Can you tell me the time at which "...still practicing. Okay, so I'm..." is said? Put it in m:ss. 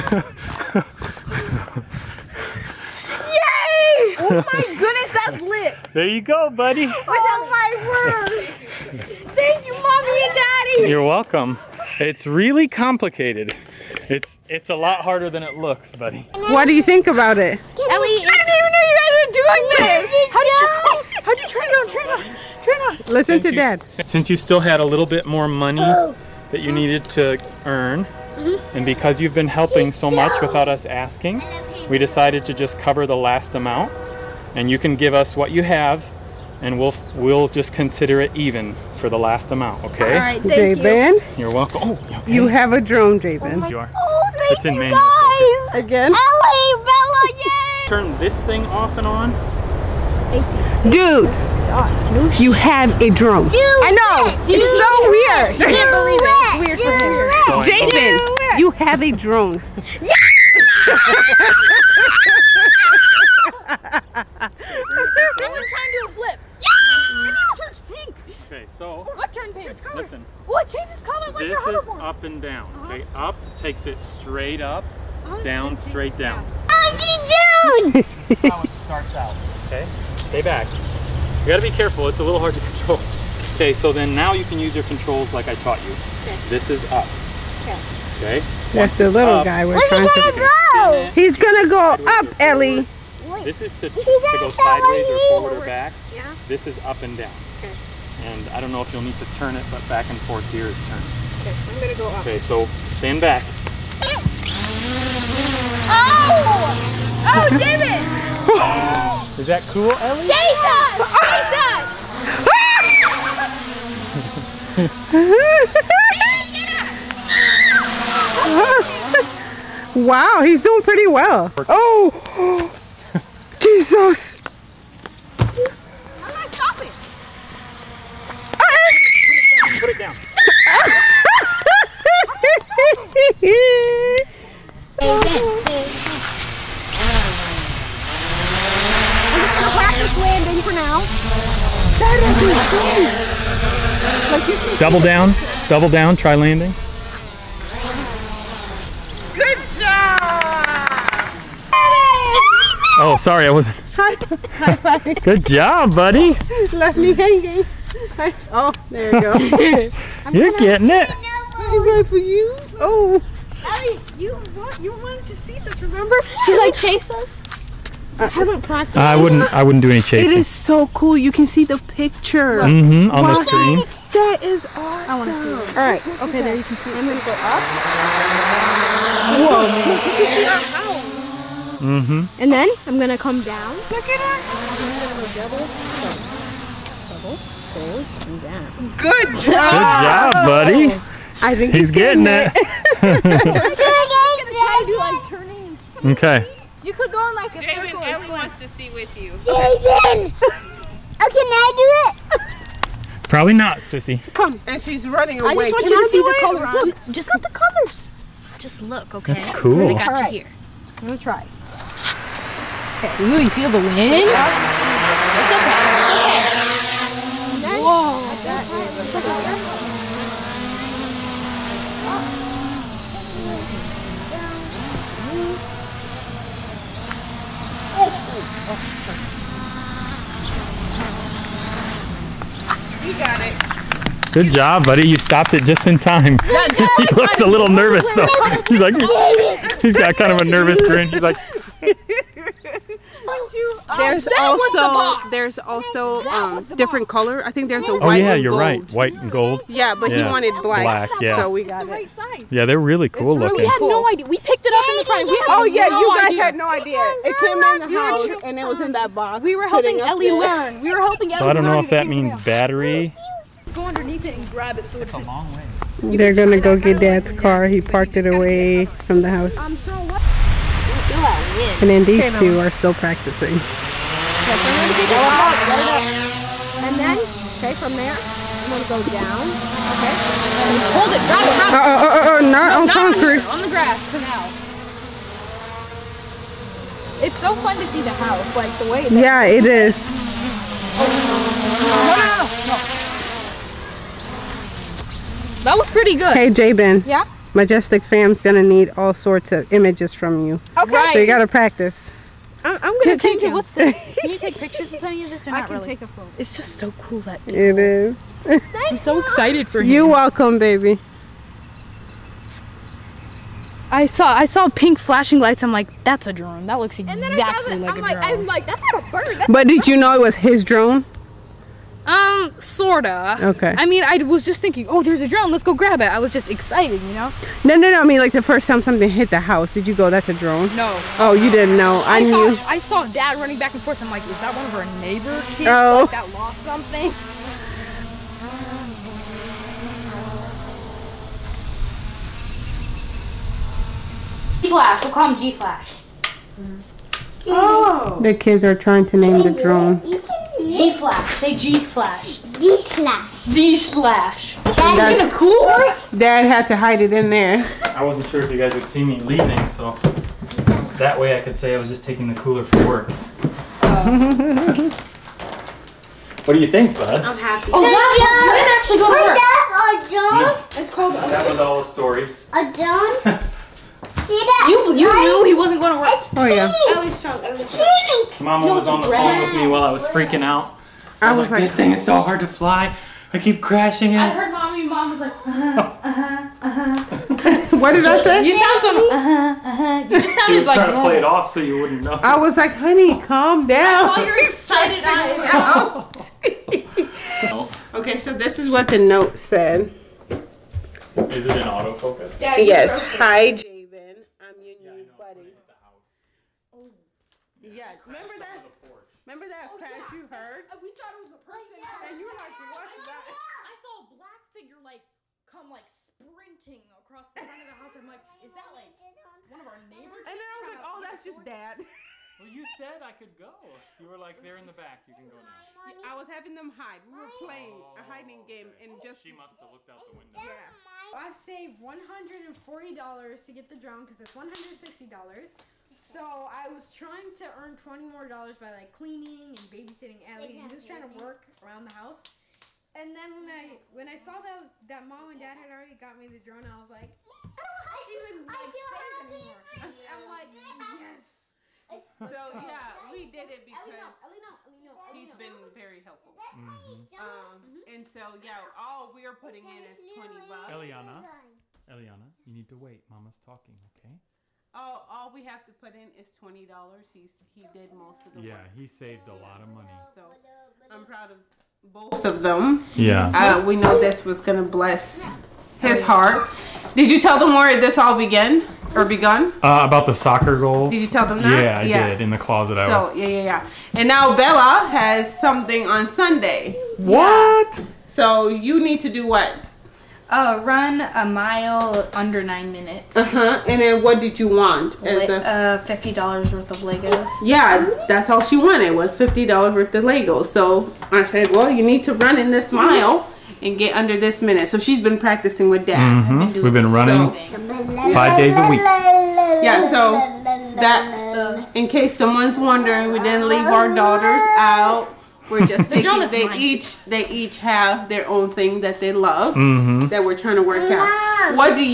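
4:32.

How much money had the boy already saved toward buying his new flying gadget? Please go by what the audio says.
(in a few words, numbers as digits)
$140.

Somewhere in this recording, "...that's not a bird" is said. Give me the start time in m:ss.
5:18.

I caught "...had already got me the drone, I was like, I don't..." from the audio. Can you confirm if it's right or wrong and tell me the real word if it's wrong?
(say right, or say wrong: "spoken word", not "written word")
right.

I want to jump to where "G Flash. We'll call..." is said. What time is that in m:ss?
5:44.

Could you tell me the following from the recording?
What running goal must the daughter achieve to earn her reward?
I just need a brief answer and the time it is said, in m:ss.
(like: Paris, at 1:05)
a mile under 9 minutes, at 8:10.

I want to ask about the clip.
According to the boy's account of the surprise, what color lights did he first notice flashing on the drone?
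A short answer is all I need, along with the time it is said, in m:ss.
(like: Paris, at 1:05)
pink, at 5:14.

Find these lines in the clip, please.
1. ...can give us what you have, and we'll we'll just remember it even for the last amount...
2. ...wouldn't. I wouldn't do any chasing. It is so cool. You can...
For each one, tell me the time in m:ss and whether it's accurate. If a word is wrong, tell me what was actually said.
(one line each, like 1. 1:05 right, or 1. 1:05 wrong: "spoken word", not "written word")
1. 0:34 wrong: "consider", not "remember"
2. 2:49 right.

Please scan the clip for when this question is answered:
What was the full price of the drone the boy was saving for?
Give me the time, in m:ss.
7:14.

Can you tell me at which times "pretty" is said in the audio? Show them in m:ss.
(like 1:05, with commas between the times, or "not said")
2:00, 4:55.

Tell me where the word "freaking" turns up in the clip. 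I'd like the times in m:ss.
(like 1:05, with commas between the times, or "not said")
6:20.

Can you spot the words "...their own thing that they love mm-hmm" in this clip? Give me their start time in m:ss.
8:38.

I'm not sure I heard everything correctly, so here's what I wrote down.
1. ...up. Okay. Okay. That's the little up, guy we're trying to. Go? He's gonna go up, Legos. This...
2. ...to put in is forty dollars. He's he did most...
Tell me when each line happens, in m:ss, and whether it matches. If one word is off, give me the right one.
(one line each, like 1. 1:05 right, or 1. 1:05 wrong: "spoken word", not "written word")
1. 1:26 wrong: "Ellie", not "Legos"
2. 7:45 wrong: "twenty", not "forty".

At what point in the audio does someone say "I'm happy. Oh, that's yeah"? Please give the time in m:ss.
6:07.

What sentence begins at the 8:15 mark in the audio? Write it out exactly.
As Le a- uh, fifty dollars worth of Legos.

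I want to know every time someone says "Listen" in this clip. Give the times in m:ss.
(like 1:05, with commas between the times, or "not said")
0:23, 1:09.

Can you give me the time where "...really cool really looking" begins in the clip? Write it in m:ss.
4:12.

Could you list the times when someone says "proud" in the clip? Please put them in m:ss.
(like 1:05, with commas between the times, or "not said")
7:51.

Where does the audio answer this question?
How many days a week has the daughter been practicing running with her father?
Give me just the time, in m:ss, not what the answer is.
8:28.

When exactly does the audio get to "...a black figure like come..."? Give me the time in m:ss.
6:54.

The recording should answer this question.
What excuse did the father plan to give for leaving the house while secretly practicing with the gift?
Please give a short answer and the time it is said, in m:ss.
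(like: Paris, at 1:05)
taking the cooler for work, at 6:02.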